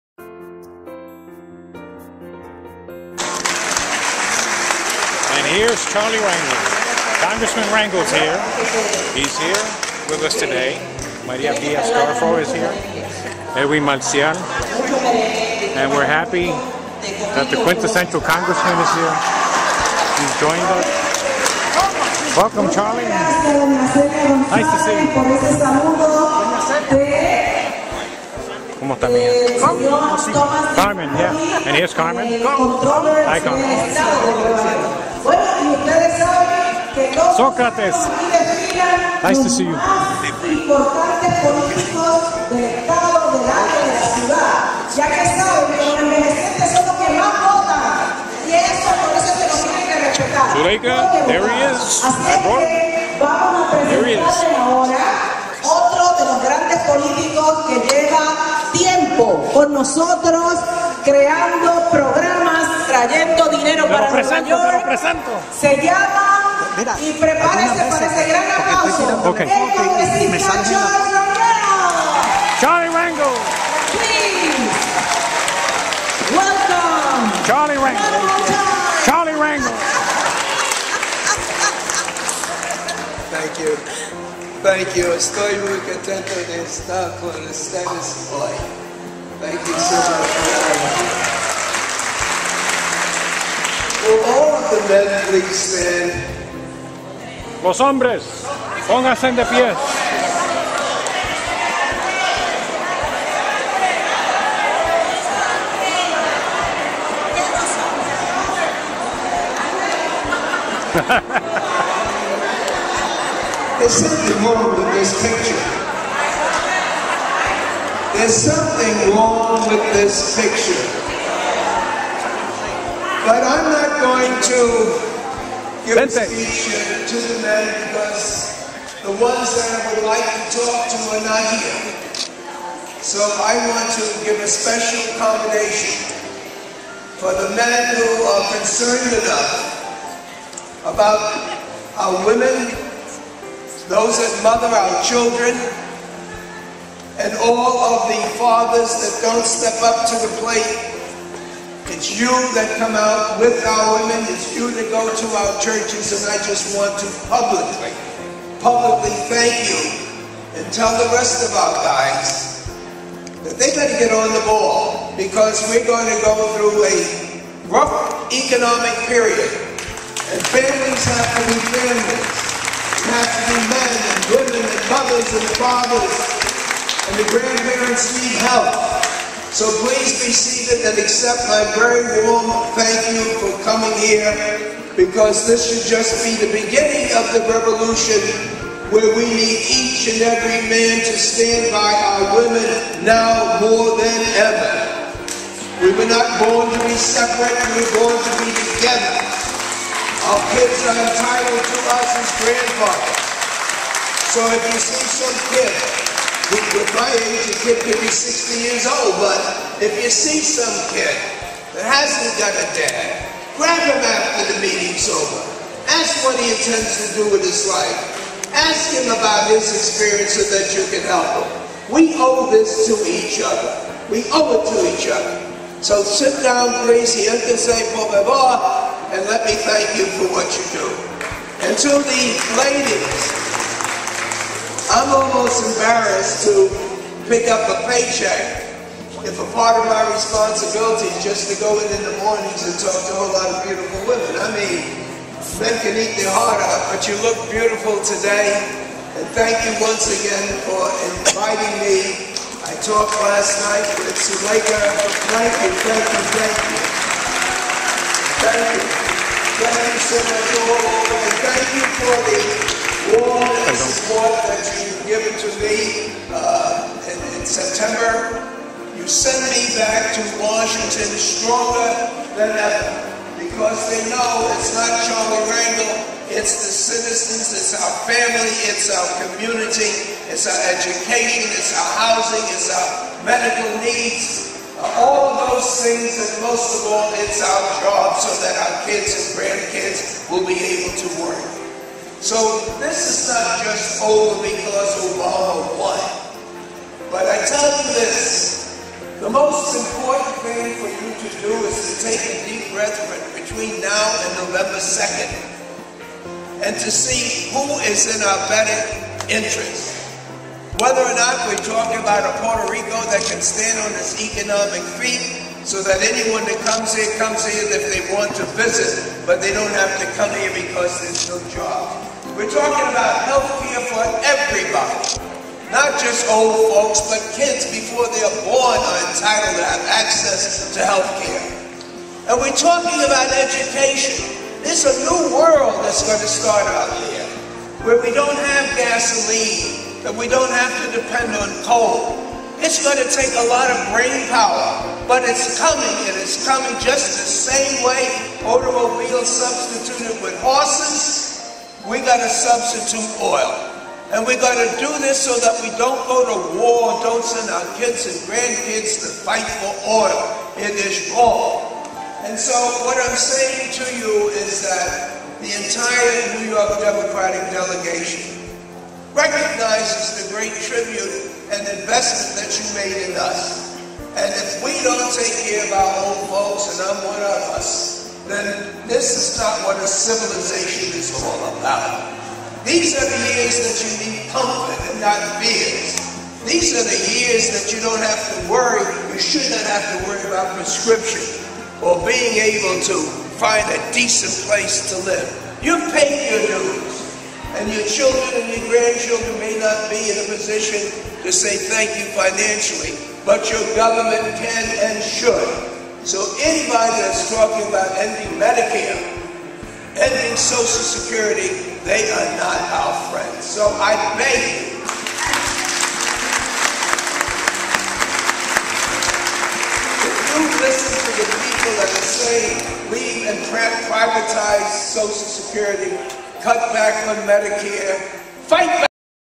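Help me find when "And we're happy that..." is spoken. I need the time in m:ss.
0:15.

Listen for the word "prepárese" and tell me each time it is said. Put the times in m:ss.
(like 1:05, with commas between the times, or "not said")
1:07.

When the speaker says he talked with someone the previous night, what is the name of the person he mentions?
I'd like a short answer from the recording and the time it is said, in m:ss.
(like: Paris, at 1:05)
Suleika, at 4:14.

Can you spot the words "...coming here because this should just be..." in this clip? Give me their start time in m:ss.
3:03.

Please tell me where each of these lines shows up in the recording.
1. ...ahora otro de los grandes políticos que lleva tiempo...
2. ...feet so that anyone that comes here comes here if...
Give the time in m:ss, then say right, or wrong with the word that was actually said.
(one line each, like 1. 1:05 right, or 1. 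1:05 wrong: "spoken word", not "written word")
1. 0:54 right
2. 5:15 right.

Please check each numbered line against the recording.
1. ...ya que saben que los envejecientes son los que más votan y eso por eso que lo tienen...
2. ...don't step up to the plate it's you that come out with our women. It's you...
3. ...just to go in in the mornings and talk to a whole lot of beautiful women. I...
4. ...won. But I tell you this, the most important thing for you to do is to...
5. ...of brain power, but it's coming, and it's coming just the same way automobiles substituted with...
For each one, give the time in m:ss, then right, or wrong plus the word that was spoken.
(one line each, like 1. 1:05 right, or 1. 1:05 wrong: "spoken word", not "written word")
1. 0:44 right
2. 2:29 right
3. 4:01 right
4. 4:55 right
5. 5:43 right.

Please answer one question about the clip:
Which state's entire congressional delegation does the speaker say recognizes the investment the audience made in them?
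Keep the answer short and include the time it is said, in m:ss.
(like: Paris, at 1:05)
New York, at 6:06.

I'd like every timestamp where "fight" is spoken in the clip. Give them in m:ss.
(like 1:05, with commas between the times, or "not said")
5:59, 7:08.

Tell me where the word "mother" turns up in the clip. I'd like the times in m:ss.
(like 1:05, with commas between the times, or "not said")
2:24, 2:54.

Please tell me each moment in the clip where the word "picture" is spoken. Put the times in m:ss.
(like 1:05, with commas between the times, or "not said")
1:55, 2:00.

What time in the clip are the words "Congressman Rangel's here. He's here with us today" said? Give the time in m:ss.
0:07.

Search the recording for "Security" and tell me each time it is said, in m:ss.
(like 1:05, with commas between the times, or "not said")
6:50, 7:05.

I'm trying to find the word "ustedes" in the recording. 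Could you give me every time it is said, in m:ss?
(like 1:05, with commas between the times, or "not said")
0:35, 1:27.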